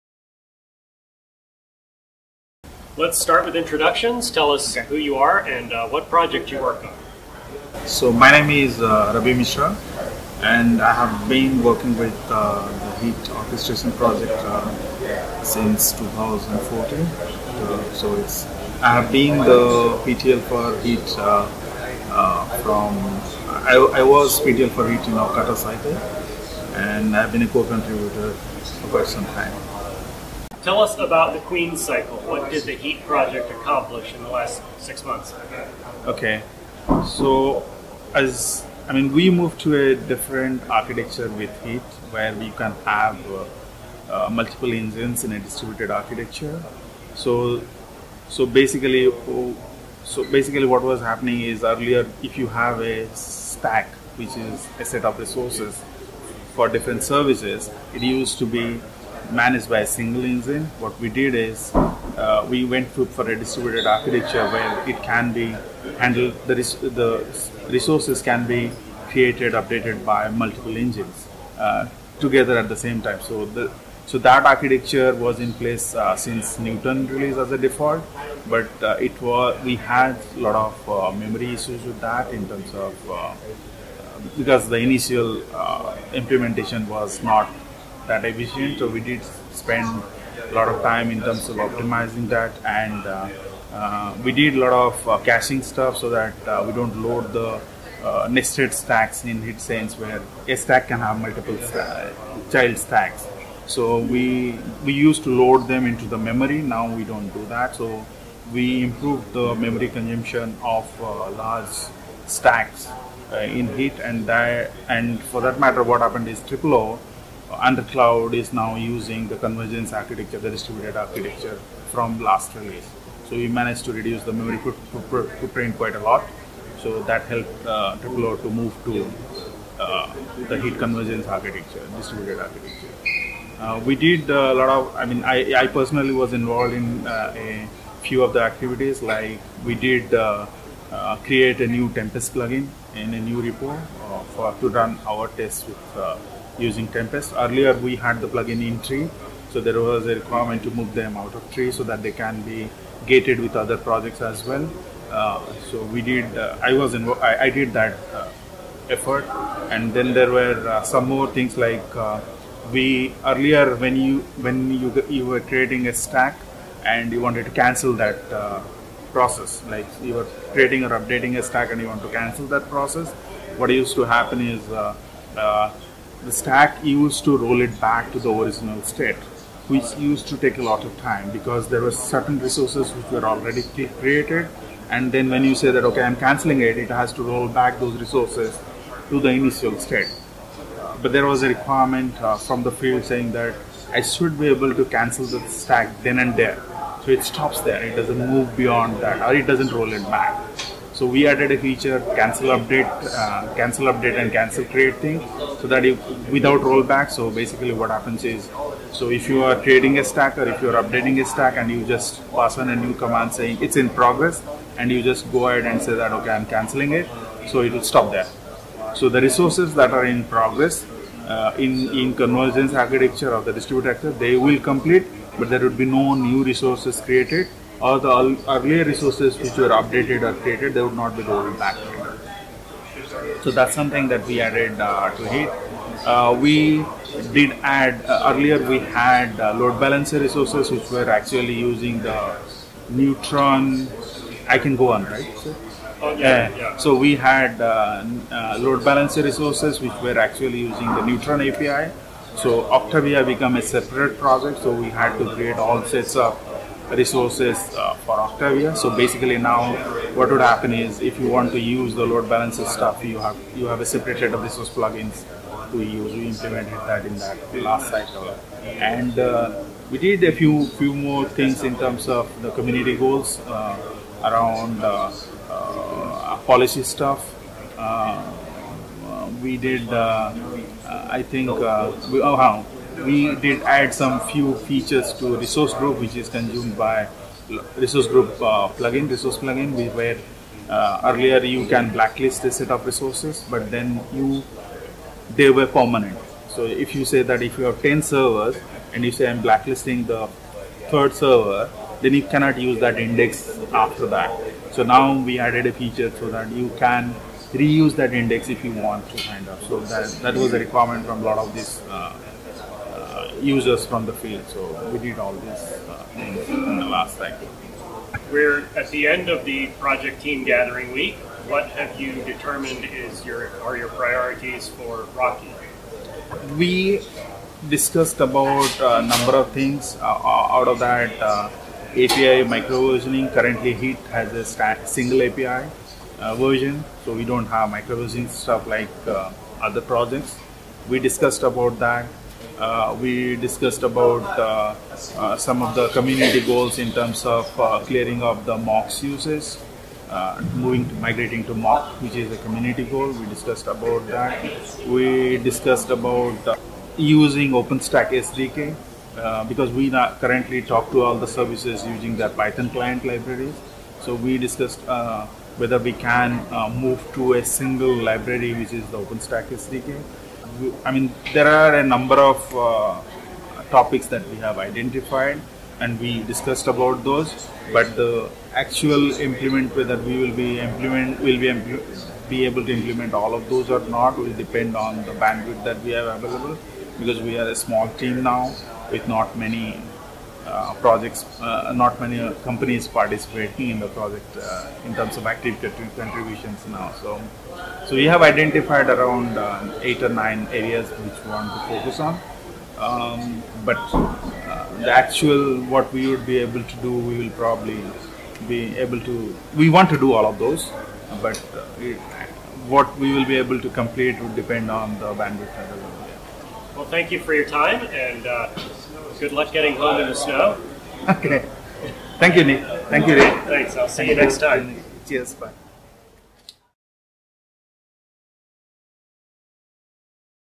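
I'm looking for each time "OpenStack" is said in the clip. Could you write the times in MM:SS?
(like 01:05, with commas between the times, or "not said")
05:57, 06:08.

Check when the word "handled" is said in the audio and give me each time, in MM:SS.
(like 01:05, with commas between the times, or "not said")
01:05.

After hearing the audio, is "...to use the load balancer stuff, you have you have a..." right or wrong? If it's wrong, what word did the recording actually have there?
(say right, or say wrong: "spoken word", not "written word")
right.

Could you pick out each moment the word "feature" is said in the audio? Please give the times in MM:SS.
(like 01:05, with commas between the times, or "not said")
03:21, 04:44, 05:05.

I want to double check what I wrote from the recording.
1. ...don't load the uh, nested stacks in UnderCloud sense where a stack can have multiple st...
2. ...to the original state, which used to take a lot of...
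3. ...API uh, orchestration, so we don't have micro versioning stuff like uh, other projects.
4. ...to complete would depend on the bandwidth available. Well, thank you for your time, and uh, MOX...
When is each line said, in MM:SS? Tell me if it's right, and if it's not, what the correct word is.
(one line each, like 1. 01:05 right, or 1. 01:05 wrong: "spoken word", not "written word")
1. 01:36 wrong: "Heat", not "UnderCloud"
2. 02:58 right
3. 05:35 wrong: "version", not "orchestration"
4. 06:53 wrong: "Good", not "MOX".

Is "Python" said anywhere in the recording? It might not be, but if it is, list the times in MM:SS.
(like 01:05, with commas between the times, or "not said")
06:02.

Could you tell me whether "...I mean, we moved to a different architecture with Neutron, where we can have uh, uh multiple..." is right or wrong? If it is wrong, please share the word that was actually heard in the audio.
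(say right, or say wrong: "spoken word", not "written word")
wrong: "Heat", not "Neutron".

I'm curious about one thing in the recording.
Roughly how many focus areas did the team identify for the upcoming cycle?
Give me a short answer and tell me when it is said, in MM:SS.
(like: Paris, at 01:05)
8 or 9, at 06:39.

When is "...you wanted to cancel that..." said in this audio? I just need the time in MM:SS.
02:47.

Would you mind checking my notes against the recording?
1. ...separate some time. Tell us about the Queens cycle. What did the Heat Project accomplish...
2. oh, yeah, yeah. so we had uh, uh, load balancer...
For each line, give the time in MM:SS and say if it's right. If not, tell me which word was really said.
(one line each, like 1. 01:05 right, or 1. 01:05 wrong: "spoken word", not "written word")
1. 00:28 wrong: "quite", not "separate"
2. 04:06 right.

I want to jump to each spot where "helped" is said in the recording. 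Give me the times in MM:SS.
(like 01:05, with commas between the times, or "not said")
02:07.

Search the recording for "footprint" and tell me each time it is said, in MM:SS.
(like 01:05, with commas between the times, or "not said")
02:04.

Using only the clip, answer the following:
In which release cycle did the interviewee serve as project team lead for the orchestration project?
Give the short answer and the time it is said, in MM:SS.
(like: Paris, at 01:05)
Ocata, at 00:25.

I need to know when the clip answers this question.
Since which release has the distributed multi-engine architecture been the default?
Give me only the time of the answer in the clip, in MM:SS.
01:16.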